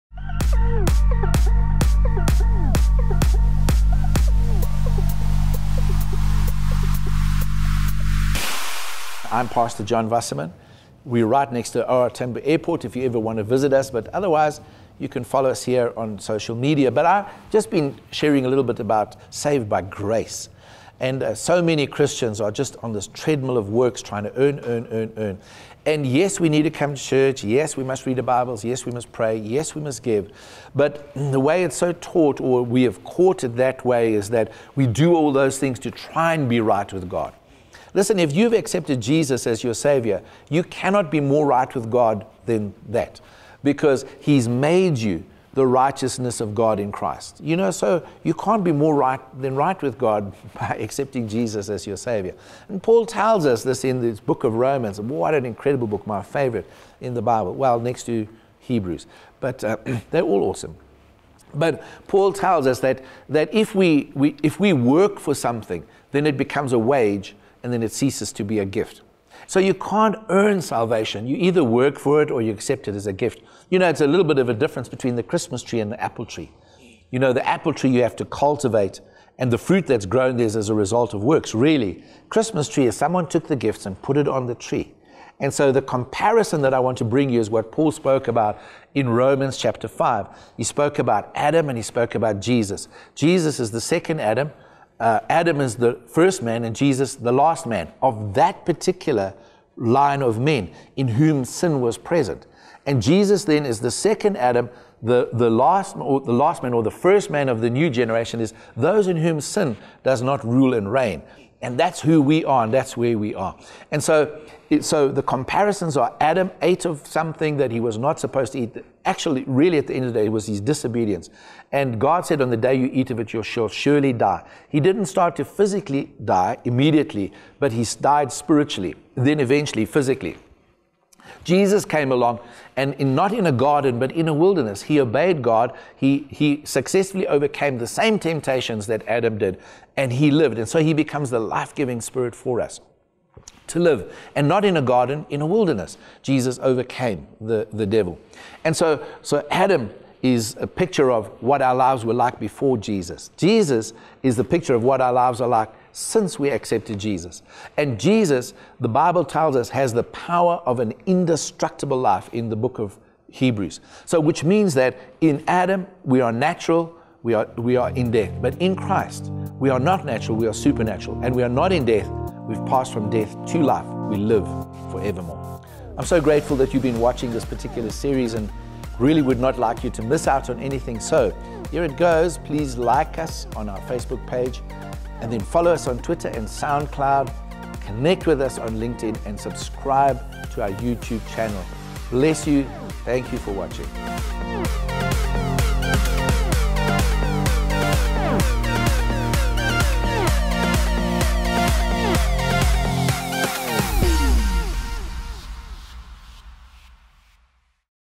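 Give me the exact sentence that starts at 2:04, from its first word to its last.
He didn't start to physically die immediately, but he died spiritually, then eventually physically.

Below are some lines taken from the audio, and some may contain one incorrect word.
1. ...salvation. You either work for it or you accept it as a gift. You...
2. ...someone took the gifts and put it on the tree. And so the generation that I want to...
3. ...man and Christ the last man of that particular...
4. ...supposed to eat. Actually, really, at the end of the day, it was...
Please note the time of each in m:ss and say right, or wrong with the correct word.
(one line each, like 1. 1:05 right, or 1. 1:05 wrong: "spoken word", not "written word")
1. 1:10 right
2. 1:22 wrong: "comparison", not "generation"
3. 1:36 wrong: "Jesus", not "Christ"
4. 1:58 right.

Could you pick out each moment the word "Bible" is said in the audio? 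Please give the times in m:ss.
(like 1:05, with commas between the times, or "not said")
0:28, 0:57, 2:38.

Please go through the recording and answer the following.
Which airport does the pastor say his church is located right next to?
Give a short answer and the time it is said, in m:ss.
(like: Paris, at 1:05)
OR Tambo Airport, at 0:12.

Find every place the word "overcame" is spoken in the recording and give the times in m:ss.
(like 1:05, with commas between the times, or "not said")
2:17, 2:26.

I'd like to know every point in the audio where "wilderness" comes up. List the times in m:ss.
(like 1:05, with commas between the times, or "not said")
2:14, 2:25.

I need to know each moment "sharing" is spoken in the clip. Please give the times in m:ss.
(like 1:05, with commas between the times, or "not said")
0:18.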